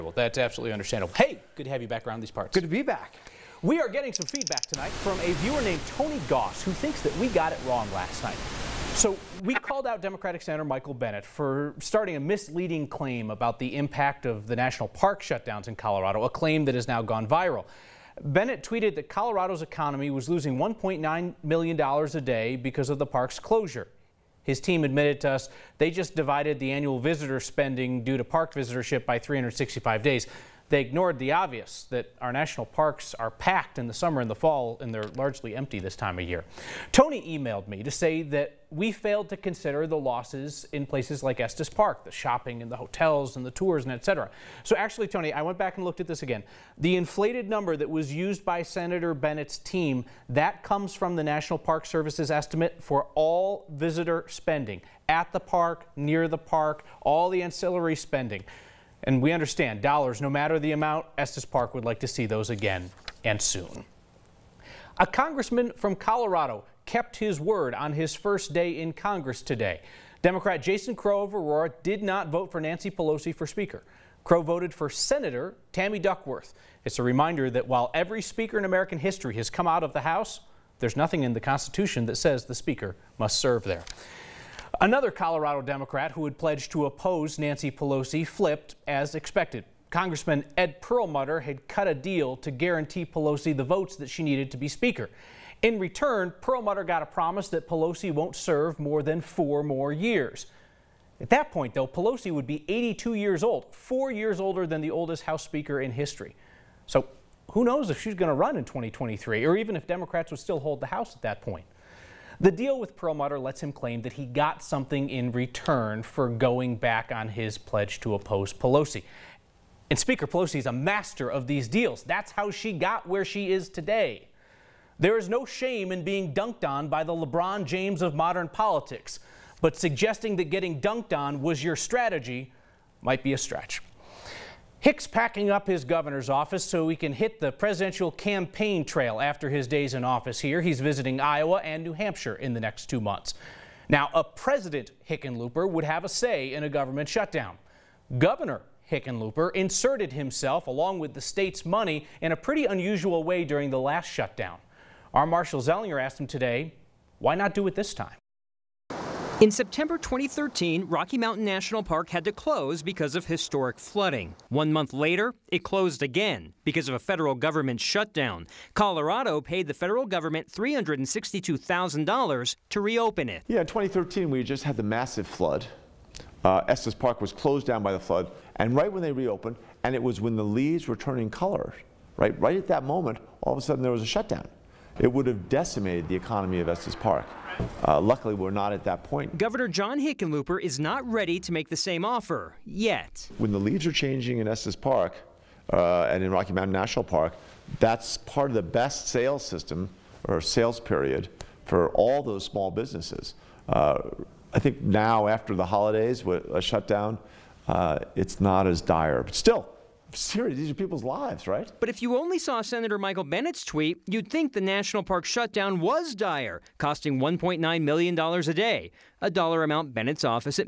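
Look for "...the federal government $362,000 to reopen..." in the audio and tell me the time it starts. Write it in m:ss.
2:49.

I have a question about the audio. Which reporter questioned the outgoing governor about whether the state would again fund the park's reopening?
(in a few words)
Marshall Zelinger.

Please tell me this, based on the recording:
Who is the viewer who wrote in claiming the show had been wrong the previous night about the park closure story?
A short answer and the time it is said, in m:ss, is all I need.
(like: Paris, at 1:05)
Tony Goss, at 0:05.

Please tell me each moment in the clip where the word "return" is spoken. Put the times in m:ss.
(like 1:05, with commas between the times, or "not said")
1:35, 1:55.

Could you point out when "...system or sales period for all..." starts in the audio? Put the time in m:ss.
3:19.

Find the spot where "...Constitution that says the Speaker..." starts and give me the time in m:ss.
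1:21.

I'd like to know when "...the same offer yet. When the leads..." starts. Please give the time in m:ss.
3:11.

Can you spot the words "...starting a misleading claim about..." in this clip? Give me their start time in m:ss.
0:11.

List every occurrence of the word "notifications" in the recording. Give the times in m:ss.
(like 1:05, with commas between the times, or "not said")
not said.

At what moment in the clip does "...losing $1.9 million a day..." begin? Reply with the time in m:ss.
0:20.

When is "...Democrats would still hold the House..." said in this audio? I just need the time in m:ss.
1:49.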